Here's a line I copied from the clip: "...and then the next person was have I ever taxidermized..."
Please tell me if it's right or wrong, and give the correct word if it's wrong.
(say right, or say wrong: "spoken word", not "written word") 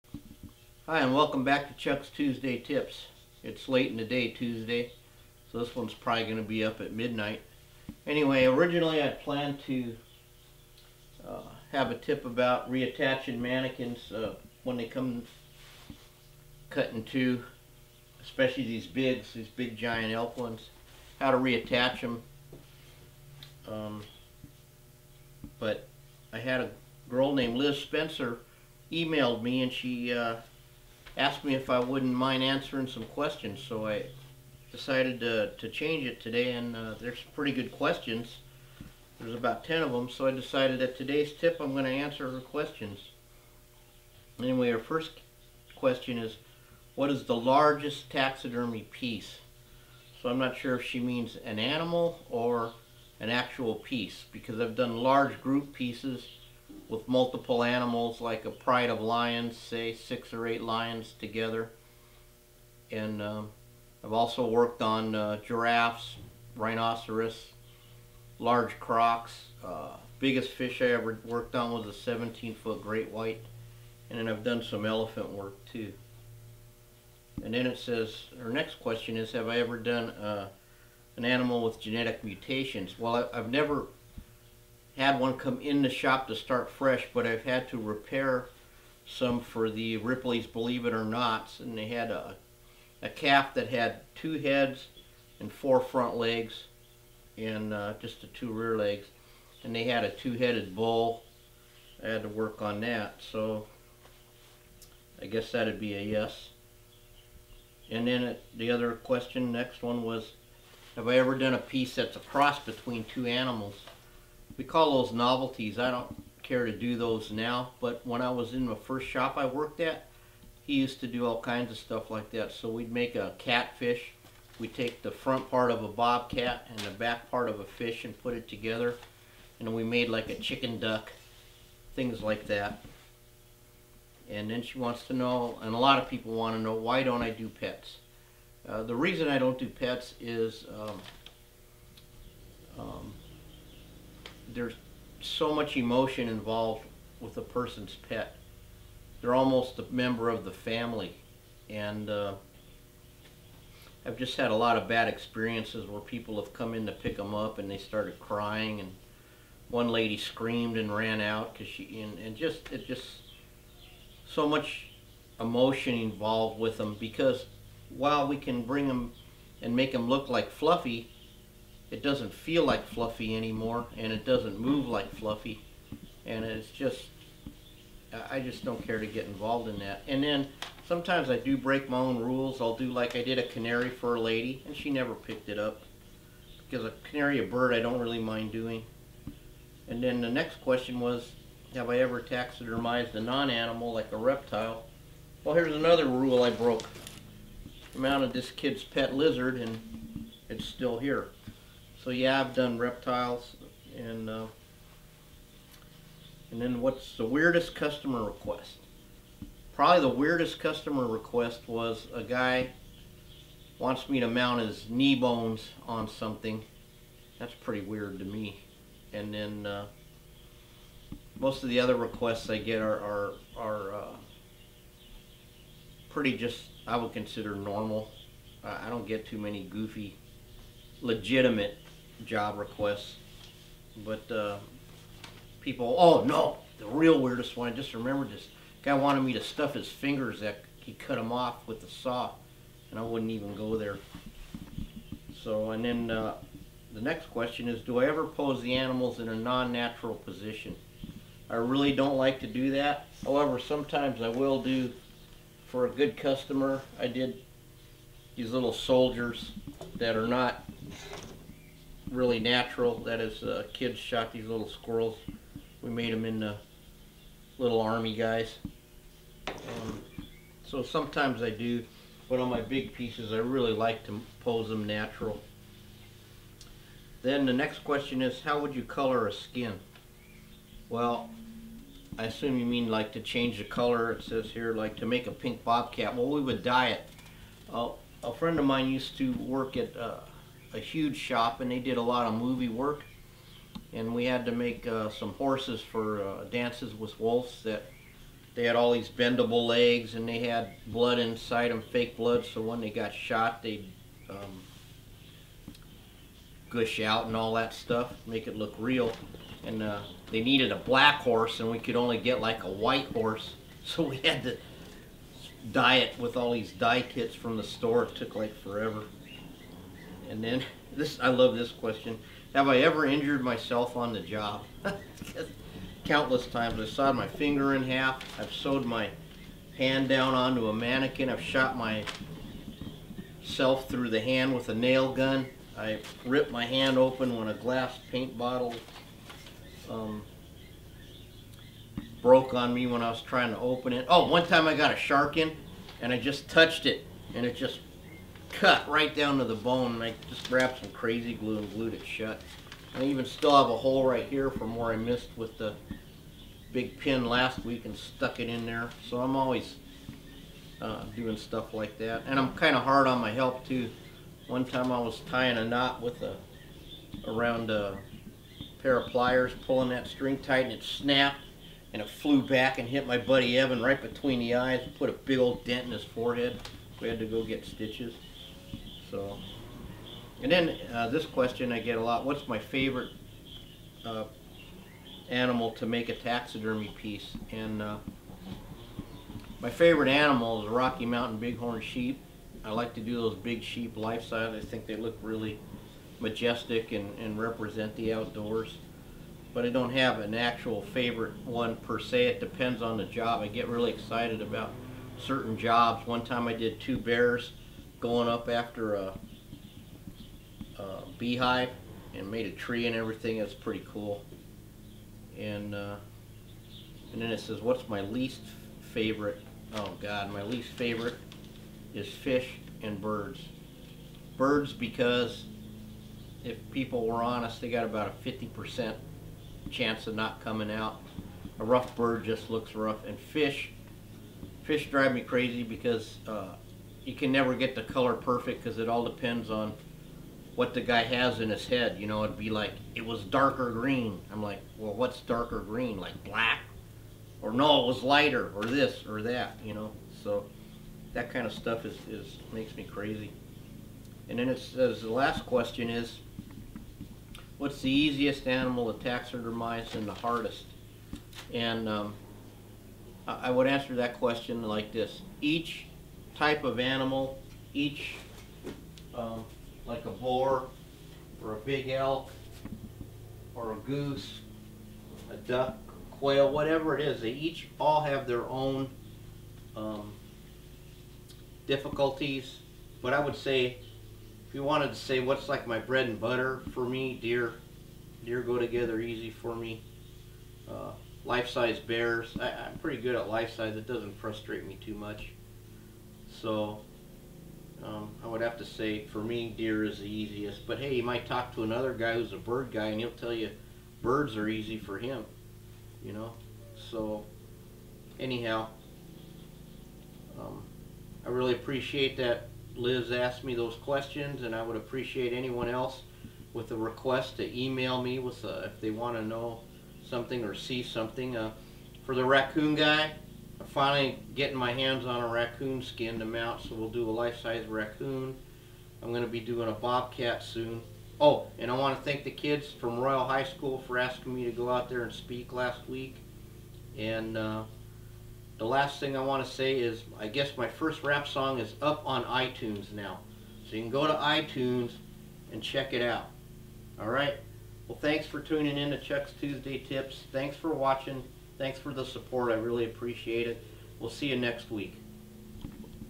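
wrong: "question", not "person".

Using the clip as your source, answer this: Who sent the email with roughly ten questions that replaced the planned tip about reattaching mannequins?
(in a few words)
Liz Spencer.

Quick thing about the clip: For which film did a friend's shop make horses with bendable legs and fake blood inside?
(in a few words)
Dances with Wolves.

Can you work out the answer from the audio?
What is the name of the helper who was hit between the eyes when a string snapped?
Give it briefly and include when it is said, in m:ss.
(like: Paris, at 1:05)
Evan, at 6:13.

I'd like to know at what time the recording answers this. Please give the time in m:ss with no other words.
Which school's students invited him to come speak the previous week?
8:52.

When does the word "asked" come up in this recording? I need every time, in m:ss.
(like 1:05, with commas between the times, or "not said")
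0:31, 8:33.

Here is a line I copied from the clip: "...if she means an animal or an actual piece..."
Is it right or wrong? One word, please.
right.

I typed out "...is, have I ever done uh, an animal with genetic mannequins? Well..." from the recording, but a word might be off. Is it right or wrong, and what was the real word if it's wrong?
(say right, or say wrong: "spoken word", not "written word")
wrong: "mutations", not "mannequins".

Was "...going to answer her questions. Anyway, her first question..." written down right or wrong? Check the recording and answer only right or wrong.
right.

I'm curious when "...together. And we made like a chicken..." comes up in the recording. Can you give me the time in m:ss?
2:08.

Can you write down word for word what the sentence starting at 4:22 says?
That is, uh, kids shot these little squirrels.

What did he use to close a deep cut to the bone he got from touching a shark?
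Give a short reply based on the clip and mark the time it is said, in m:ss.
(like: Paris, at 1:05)
crazy glue, at 5:50.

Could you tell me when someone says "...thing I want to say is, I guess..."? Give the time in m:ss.
8:58.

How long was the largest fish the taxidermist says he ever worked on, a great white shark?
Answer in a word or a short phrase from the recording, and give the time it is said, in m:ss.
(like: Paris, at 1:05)
17 foot, at 1:11.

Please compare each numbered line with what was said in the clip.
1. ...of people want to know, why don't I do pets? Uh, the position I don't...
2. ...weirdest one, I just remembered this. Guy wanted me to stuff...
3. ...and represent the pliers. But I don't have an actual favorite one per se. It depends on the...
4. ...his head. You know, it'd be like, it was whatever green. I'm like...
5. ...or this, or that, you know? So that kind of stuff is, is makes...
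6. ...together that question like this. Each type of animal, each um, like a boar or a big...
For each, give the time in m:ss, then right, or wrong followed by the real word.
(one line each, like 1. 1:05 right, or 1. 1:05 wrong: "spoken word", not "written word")
1. 2:15 wrong: "reason", not "position"
2. 3:57 right
3. 6:37 wrong: "outdoors", not "pliers"
4. 7:21 wrong: "darker", not "whatever"
5. 7:28 right
6. 7:43 wrong: "answer", not "together".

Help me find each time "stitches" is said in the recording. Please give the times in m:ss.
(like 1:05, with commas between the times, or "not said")
6:17.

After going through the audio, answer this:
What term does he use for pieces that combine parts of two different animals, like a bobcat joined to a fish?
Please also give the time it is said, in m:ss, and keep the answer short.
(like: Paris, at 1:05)
novelties, at 1:55.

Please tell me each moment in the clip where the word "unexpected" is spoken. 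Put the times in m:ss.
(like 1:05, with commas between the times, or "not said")
not said.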